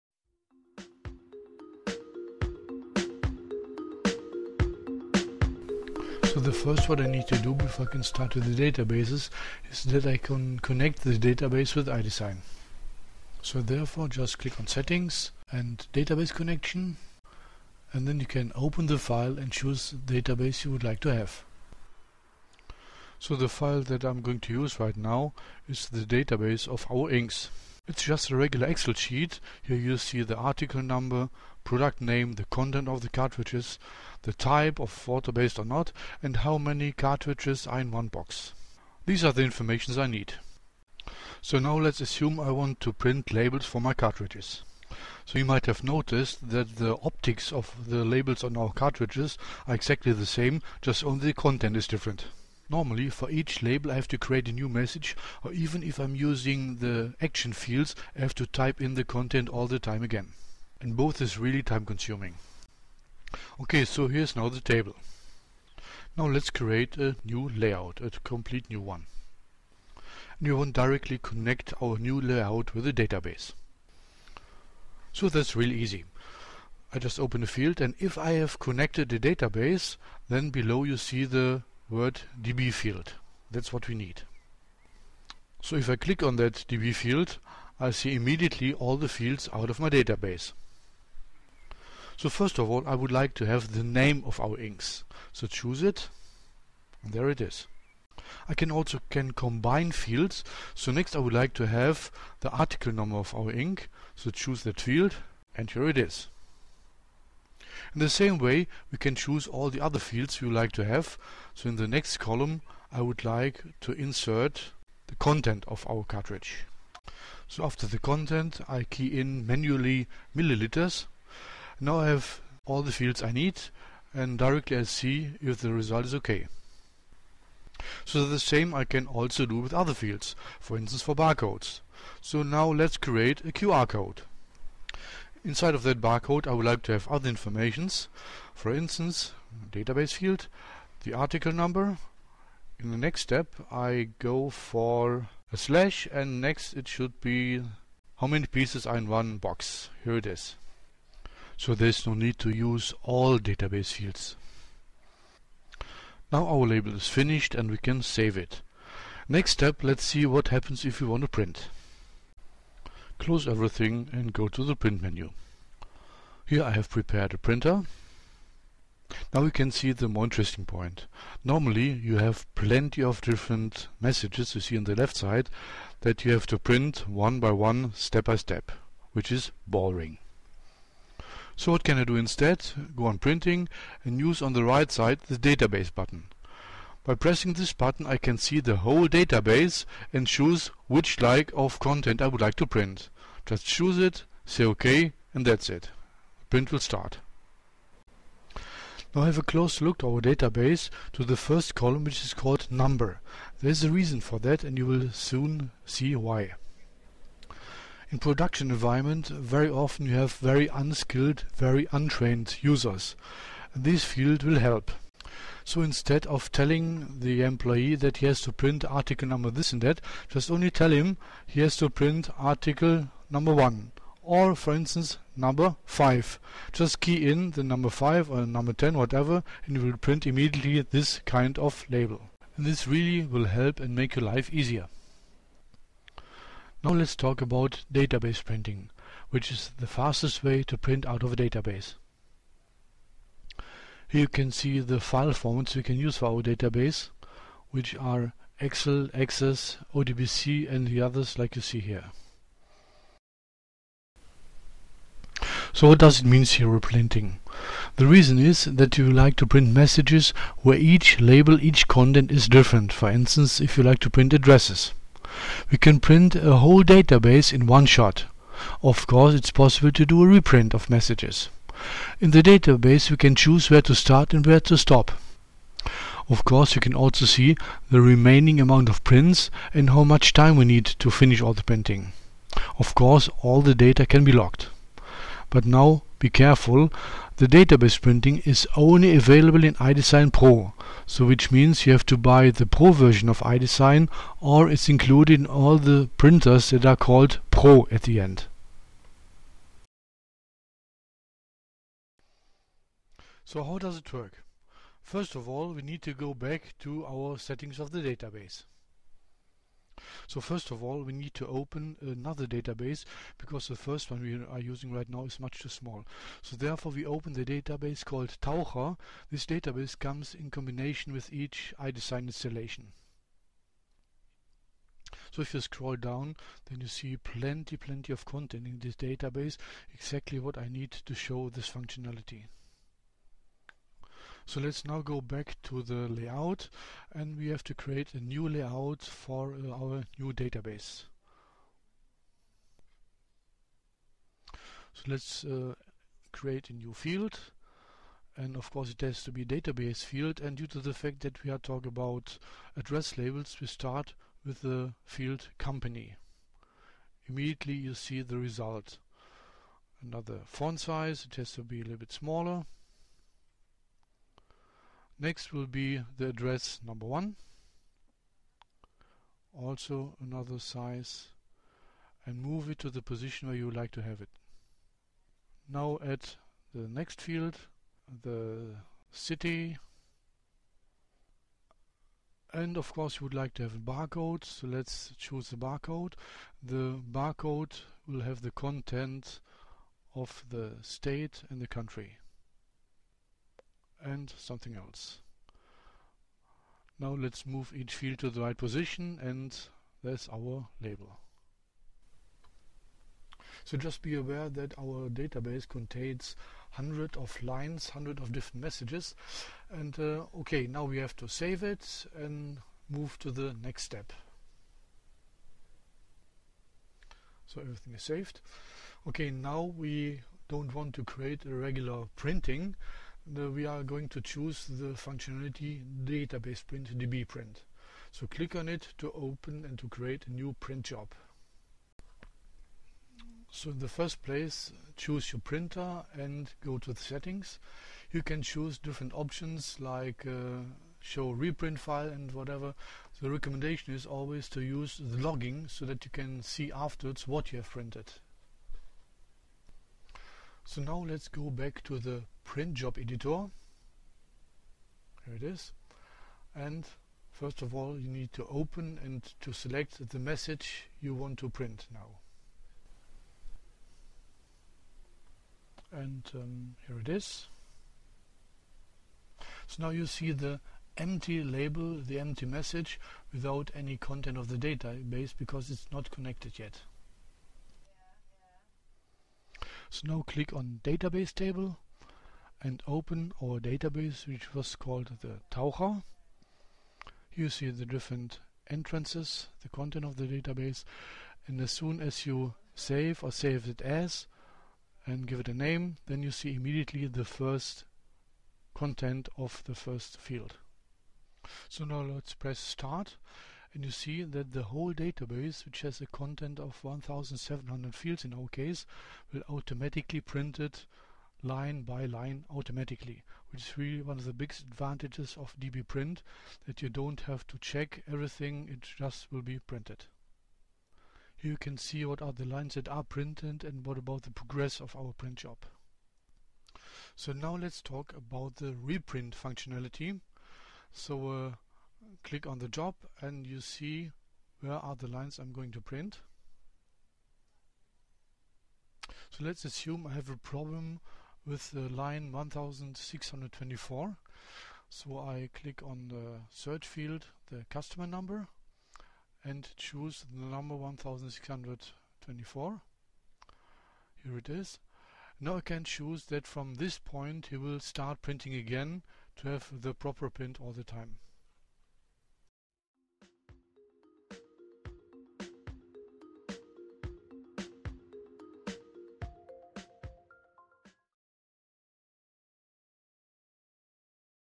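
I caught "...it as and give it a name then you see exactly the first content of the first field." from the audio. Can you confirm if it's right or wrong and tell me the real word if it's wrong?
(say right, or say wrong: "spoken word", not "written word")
wrong: "immediately", not "exactly".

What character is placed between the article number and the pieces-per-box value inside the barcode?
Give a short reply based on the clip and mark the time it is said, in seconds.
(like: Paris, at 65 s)
slash, at 145 s.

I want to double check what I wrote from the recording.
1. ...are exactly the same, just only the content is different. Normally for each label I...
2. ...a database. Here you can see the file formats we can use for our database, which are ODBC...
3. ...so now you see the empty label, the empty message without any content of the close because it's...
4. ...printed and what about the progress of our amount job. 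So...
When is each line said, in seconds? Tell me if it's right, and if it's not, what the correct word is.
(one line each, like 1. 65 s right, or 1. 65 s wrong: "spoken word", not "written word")
1. 49 s right
2. 241 s wrong: "Excel", not "ODBC"
3. 469 s wrong: "database", not "close"
4. 523 s wrong: "print", not "amount".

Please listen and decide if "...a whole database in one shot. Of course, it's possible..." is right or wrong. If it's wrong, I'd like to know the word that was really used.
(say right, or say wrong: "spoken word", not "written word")
right.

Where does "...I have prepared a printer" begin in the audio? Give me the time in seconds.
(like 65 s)
166 s.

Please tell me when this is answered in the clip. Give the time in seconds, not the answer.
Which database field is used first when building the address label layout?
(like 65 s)
355 s.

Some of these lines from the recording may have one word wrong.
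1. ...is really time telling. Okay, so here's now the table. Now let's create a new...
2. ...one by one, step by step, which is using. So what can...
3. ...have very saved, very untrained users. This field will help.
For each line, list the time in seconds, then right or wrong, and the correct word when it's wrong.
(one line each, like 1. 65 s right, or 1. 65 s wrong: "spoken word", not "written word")
1. 61 s wrong: "consuming", not "telling"
2. 177 s wrong: "boring", not "using"
3. 210 s wrong: "unskilled", not "saved".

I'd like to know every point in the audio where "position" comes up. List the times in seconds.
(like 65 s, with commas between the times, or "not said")
373 s, 398 s.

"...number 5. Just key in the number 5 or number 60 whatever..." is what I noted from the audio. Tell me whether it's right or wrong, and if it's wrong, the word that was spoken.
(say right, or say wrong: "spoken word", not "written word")
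wrong: "10", not "60".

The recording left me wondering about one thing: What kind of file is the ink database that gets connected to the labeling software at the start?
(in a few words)
Excel sheet.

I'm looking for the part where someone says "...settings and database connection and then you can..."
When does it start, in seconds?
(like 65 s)
14 s.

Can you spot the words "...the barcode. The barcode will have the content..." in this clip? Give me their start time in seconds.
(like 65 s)
385 s.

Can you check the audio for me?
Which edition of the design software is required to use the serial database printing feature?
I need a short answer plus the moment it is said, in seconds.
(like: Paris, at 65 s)
iDesign Pro, at 289 s.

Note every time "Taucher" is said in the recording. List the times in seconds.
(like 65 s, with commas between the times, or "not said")
318 s, 485 s.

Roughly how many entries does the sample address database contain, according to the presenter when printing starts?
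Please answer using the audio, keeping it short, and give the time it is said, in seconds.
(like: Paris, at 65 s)
1700, at 506 s.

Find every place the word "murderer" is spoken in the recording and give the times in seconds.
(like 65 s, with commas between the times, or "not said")
not said.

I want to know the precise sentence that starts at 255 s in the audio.
So what does it mean serial printing?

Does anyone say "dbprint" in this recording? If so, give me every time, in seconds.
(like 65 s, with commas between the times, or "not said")
515 s.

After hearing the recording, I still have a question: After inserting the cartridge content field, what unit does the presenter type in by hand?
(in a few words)
milliliters.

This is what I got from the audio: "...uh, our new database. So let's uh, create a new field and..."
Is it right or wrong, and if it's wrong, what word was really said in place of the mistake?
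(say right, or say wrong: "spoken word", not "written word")
right.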